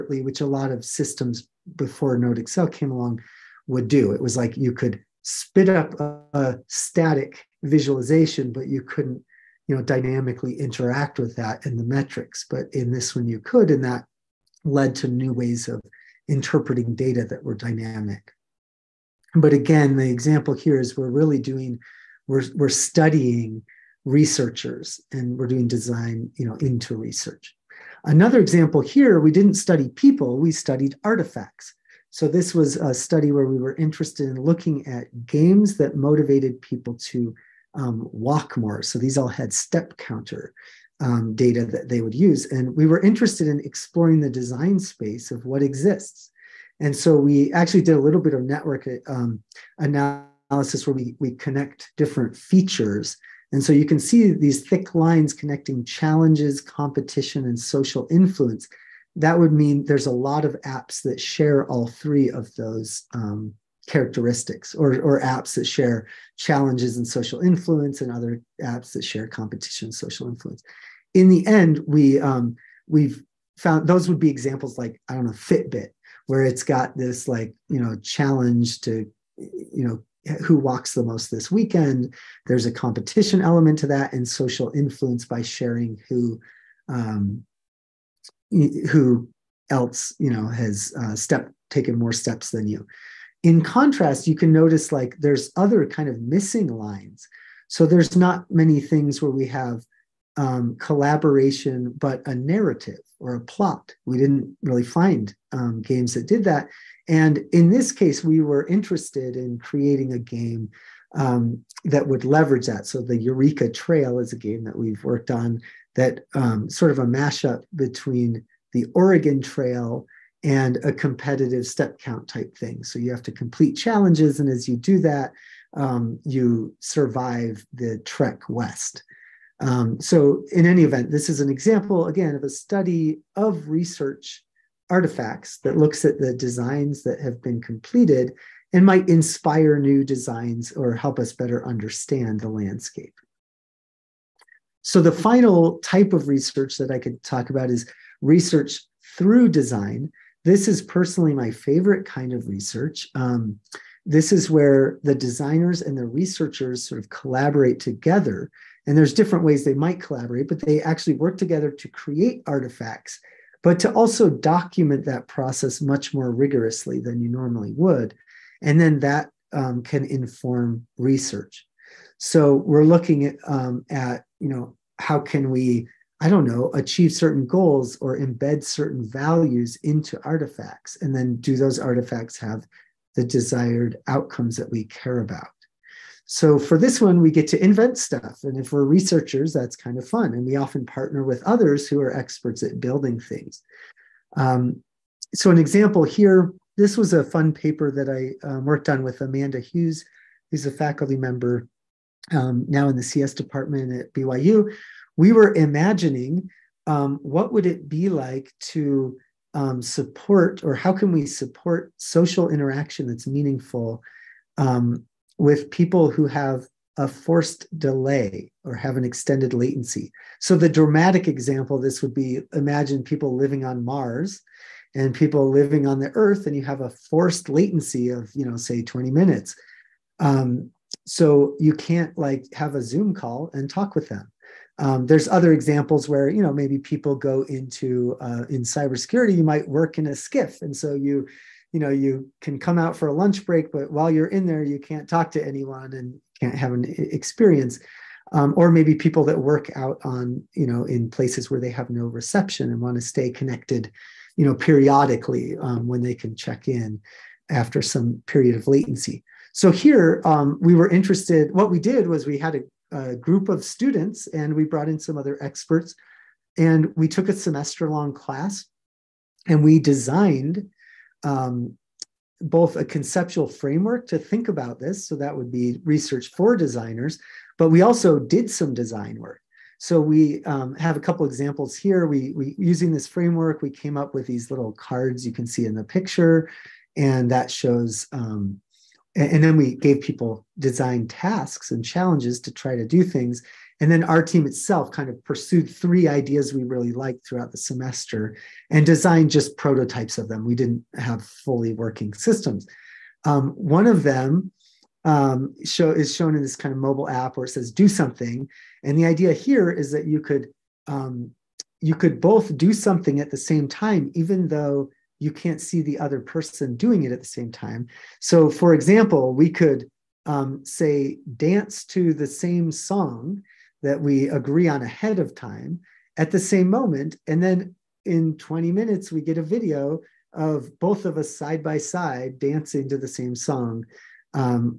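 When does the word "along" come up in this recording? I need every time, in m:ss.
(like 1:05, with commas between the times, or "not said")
0:02.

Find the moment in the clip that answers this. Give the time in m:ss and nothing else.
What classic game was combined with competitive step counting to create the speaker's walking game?
1:58.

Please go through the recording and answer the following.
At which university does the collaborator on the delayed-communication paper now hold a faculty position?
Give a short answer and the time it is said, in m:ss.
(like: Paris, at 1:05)
BYU, at 3:24.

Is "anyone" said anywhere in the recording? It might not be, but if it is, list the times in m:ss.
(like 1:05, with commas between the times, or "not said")
4:05.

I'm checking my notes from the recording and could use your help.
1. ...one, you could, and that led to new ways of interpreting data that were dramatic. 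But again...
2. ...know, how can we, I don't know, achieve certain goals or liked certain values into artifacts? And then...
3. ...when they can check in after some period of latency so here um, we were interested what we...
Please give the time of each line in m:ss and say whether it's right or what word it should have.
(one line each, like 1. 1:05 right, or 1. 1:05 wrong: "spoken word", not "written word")
1. 0:13 wrong: "dynamic", not "dramatic"
2. 2:54 wrong: "embed", not "liked"
3. 4:15 right.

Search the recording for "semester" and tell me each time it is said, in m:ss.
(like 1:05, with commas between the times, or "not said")
4:27, 4:57.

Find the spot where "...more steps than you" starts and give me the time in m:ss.
1:31.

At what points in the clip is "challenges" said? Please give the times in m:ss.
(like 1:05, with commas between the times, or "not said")
0:55, 1:06, 1:18, 2:03, 4:51.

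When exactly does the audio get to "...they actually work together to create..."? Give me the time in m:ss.
2:40.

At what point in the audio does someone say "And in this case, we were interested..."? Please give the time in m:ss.
1:47.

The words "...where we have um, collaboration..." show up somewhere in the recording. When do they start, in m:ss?
1:39.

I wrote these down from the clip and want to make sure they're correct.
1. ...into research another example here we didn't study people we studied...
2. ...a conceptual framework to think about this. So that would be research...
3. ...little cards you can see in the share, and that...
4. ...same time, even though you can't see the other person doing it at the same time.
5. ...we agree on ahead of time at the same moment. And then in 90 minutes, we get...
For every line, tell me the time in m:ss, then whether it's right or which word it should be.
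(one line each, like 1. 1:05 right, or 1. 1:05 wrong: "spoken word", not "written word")
1. 0:26 right
2. 4:32 right
3. 4:44 wrong: "picture", not "share"
4. 5:13 right
5. 5:24 wrong: "20", not "90".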